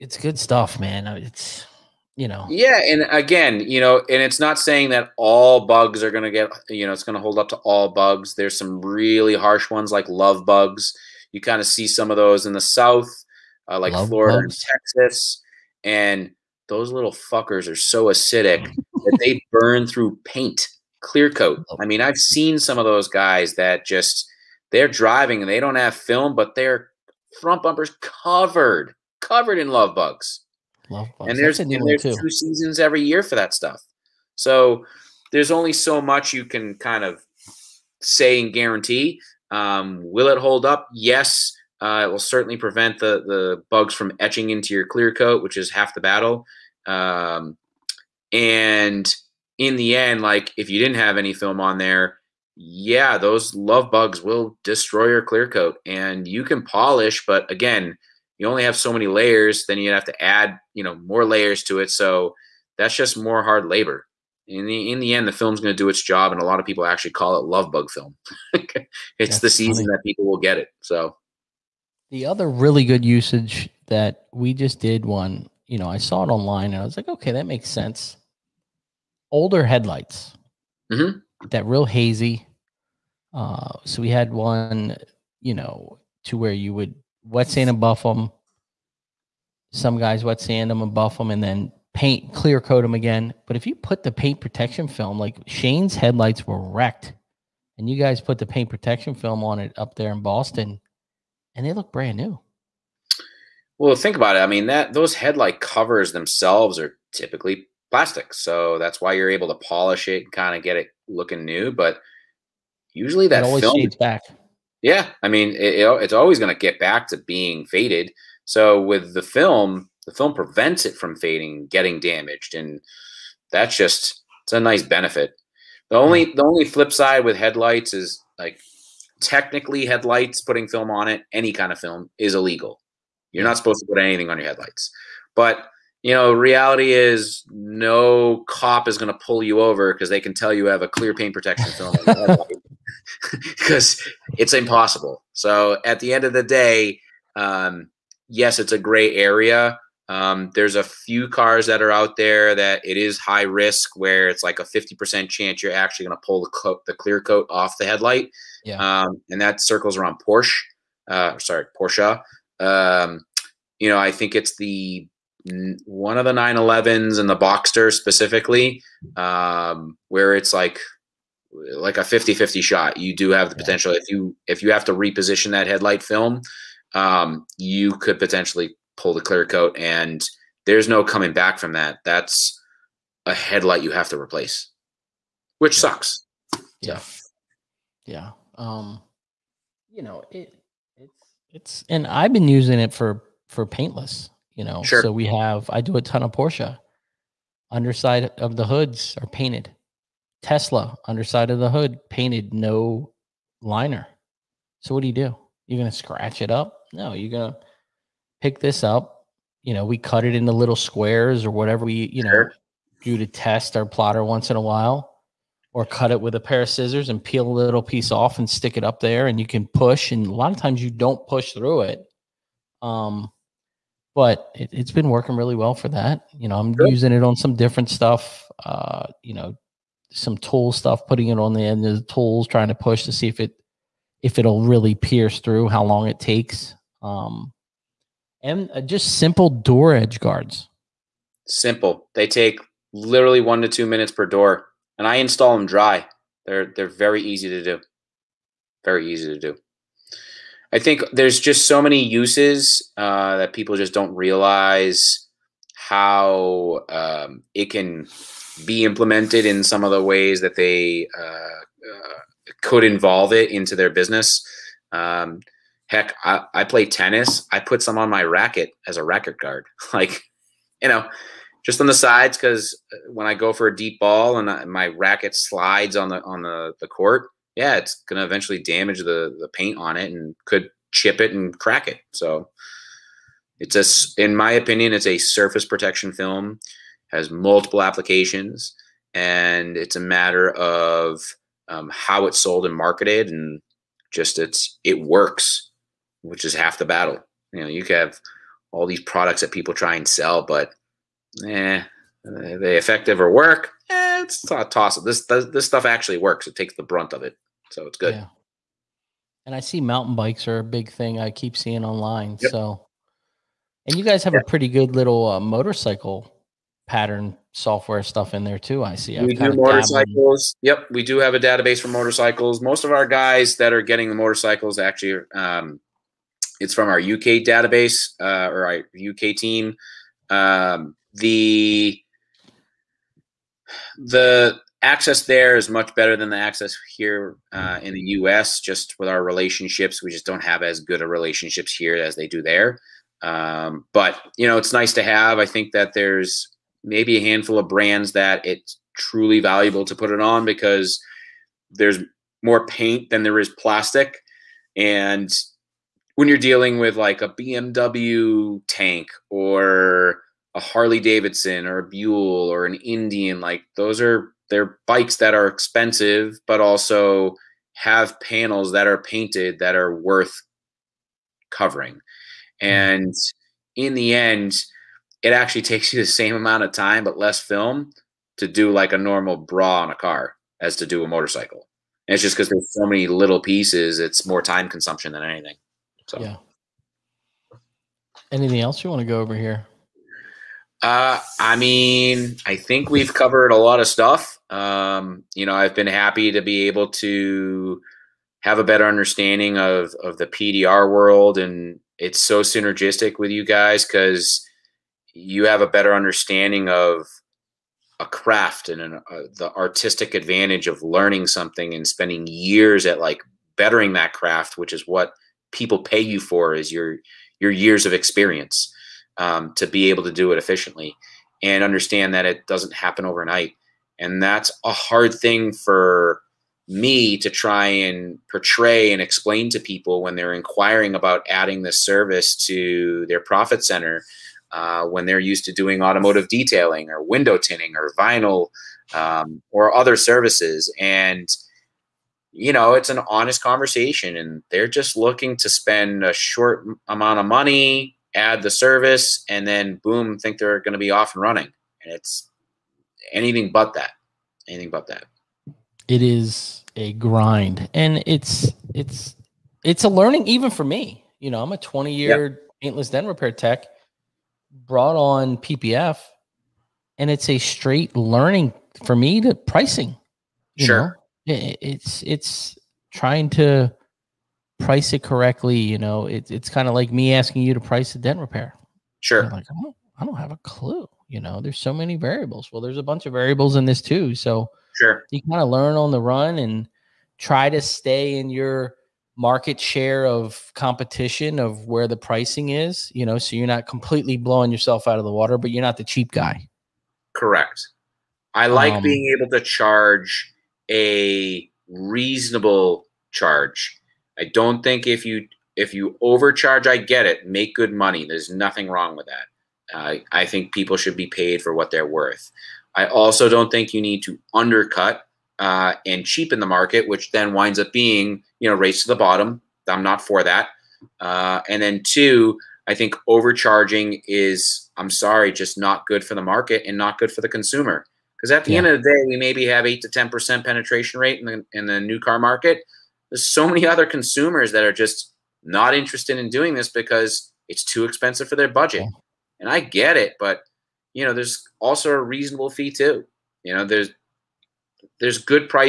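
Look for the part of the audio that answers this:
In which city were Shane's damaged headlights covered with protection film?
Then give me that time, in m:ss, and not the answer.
1:40.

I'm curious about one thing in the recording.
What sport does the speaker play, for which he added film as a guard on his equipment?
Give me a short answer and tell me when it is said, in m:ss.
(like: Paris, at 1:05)
Tennis, at 4:26.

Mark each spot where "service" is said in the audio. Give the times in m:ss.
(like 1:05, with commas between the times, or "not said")
7:11, 7:19, 7:28.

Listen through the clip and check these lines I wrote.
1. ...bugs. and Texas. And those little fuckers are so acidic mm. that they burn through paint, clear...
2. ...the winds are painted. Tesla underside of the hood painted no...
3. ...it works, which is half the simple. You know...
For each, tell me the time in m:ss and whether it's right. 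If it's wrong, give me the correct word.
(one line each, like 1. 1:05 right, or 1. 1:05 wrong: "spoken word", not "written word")
1. 0:14 right
2. 3:18 wrong: "hoods", not "winds"
3. 4:54 wrong: "battle", not "simple".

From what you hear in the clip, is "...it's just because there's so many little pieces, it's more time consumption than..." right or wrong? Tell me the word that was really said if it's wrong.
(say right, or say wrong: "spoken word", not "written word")
right.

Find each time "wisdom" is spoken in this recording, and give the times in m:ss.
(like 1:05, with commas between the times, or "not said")
not said.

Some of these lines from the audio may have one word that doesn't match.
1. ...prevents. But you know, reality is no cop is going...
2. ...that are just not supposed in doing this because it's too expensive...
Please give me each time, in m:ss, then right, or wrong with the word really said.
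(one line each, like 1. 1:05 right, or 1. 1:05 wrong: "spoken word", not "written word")
1. 2:14 wrong: "headlights", not "prevents"
2. 8:54 wrong: "interested", not "supposed".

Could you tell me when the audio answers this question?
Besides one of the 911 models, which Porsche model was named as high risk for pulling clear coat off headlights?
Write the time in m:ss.
2:47.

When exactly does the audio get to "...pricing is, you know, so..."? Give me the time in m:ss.
8:11.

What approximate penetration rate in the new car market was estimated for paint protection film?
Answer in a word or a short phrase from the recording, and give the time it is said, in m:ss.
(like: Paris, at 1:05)
8 to 10 percent, at 8:49.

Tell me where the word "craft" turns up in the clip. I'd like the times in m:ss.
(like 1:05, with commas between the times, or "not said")
6:48, 6:54.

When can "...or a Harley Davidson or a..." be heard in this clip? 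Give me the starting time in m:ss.
5:59.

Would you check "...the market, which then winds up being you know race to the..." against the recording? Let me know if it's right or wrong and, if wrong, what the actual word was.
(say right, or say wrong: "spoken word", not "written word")
right.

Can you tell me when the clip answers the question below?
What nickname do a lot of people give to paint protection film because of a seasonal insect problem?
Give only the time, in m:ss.
1:07.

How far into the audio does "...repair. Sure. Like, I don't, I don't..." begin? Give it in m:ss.
7:58.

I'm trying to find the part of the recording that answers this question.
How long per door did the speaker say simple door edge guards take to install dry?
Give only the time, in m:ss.
4:03.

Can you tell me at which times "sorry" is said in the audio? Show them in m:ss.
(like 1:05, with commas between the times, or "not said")
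2:41, 8:44.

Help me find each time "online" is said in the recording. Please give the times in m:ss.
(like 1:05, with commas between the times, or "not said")
1:16, 5:11.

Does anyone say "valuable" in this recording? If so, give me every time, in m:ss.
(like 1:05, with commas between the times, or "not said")
5:49.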